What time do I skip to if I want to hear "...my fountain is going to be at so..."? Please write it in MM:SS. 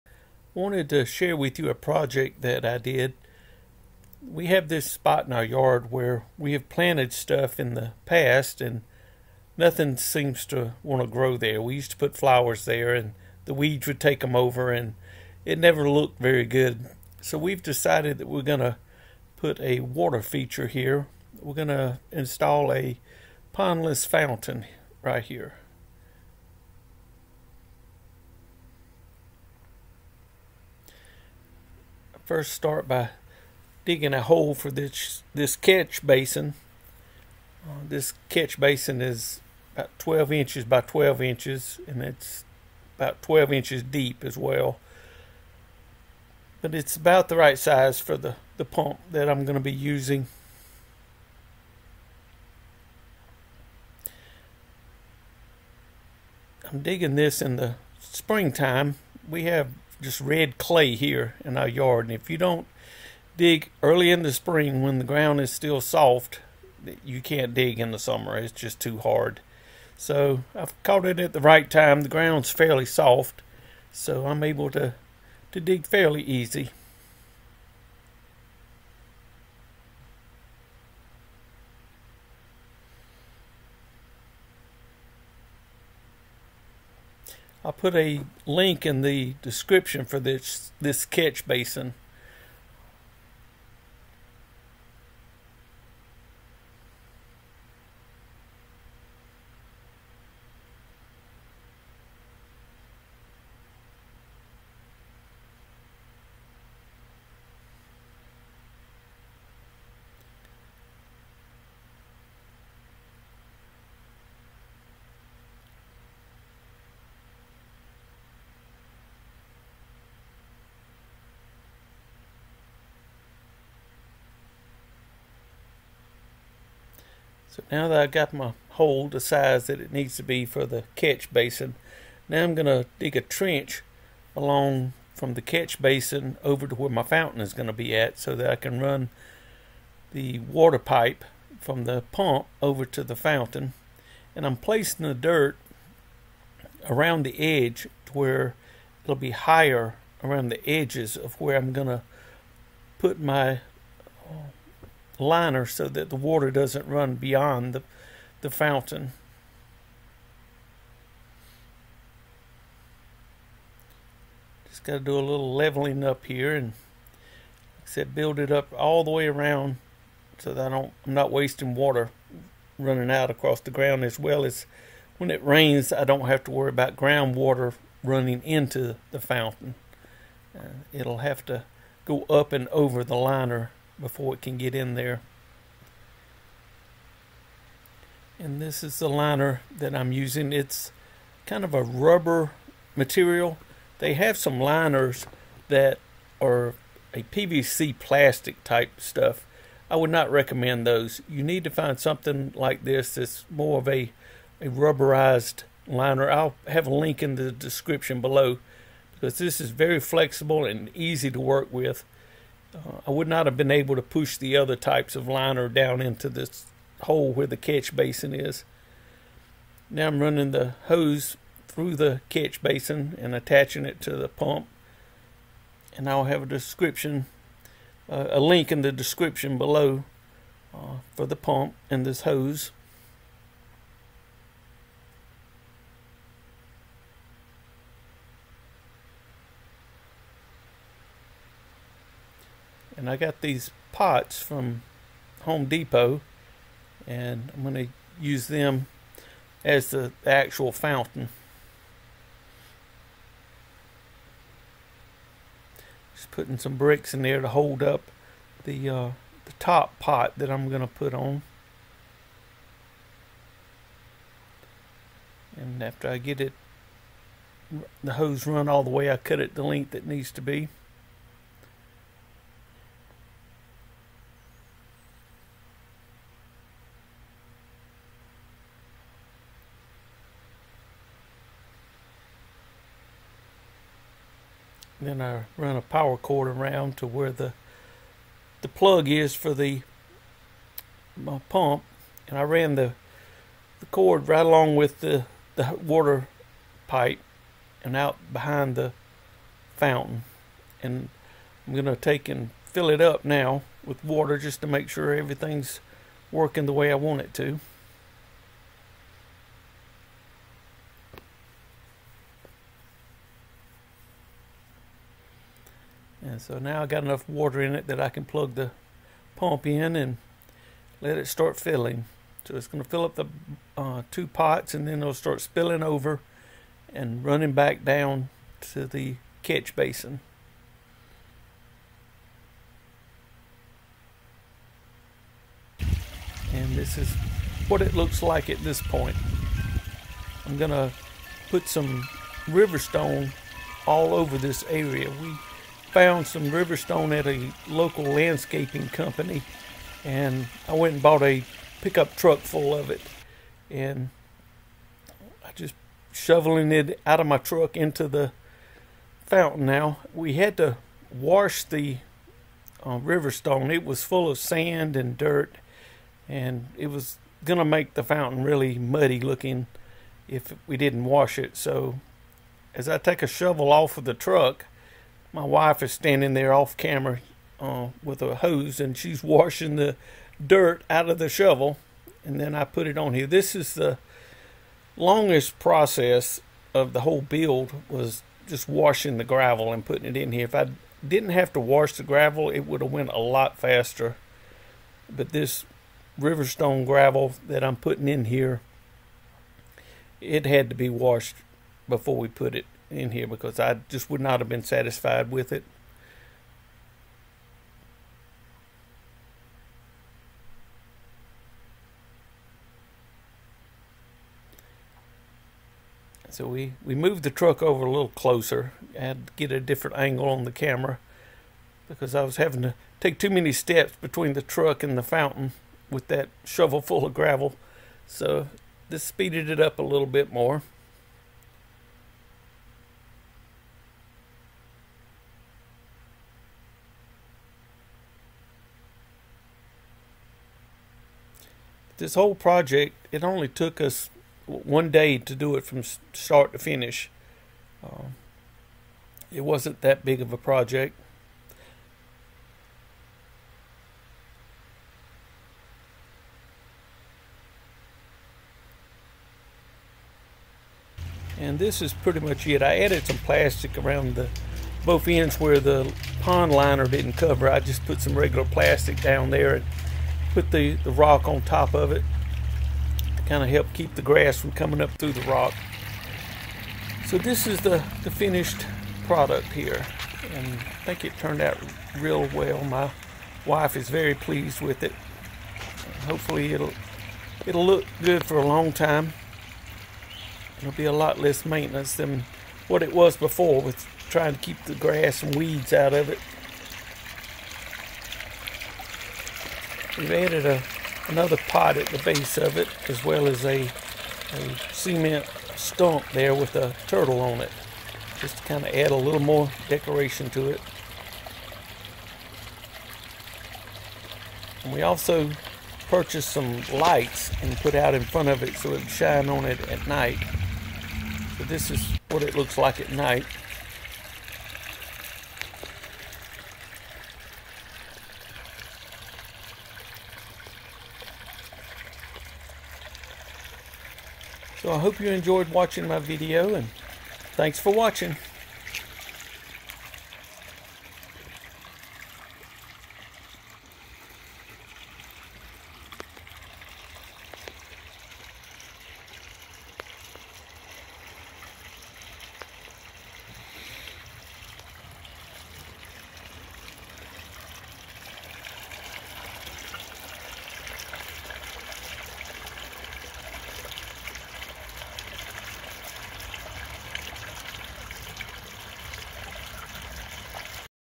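02:16.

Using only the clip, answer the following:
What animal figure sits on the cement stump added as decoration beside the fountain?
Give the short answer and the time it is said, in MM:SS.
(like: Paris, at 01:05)
turtle, at 08:26.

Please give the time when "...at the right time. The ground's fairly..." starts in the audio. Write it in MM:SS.
01:11.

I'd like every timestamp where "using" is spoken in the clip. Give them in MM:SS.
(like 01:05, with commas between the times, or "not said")
00:49, 03:10.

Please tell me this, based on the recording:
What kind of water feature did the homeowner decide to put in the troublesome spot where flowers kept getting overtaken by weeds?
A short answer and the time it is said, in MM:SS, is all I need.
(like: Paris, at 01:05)
pondless fountain, at 00:23.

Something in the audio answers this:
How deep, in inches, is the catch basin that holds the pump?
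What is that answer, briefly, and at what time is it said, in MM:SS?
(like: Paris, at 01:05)
12 inches, at 00:43.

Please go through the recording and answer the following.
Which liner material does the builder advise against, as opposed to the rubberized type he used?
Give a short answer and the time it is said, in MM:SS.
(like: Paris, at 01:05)
PVC plastic, at 03:17.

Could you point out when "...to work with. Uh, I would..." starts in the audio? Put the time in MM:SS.
03:31.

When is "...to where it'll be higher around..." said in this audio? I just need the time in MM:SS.
02:28.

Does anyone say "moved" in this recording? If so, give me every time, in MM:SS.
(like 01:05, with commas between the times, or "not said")
06:56.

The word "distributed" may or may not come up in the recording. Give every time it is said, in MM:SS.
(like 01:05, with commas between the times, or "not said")
not said.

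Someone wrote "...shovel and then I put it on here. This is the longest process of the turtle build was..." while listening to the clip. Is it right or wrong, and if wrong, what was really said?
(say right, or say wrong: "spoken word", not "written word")
wrong: "whole", not "turtle".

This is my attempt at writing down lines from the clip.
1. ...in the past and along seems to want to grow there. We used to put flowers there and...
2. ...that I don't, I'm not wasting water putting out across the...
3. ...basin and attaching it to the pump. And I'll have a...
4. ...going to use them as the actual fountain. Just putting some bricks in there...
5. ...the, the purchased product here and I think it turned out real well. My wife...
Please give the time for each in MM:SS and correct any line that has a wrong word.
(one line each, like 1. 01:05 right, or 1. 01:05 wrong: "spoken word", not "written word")
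1. 00:07 wrong: "nothing", not "along"
2. 02:50 wrong: "running", not "putting"
3. 03:42 right
4. 04:07 right
5. 07:57 wrong: "finished", not "purchased".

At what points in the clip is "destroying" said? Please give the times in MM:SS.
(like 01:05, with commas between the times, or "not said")
not said.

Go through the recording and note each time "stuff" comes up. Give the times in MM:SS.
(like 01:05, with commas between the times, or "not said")
00:07, 03:18.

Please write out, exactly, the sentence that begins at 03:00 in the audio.
Uh, it'll have to go up and over the liner before it can get in there.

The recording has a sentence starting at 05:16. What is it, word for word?
so now I got enough water in it that I can plug the pump in and let it start filling.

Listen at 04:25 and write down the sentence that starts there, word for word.
And after I get it, the hose run all the way, I cut it the length that needs to be.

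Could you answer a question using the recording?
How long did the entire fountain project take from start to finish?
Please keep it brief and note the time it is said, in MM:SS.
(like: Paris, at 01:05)
one day, at 07:24.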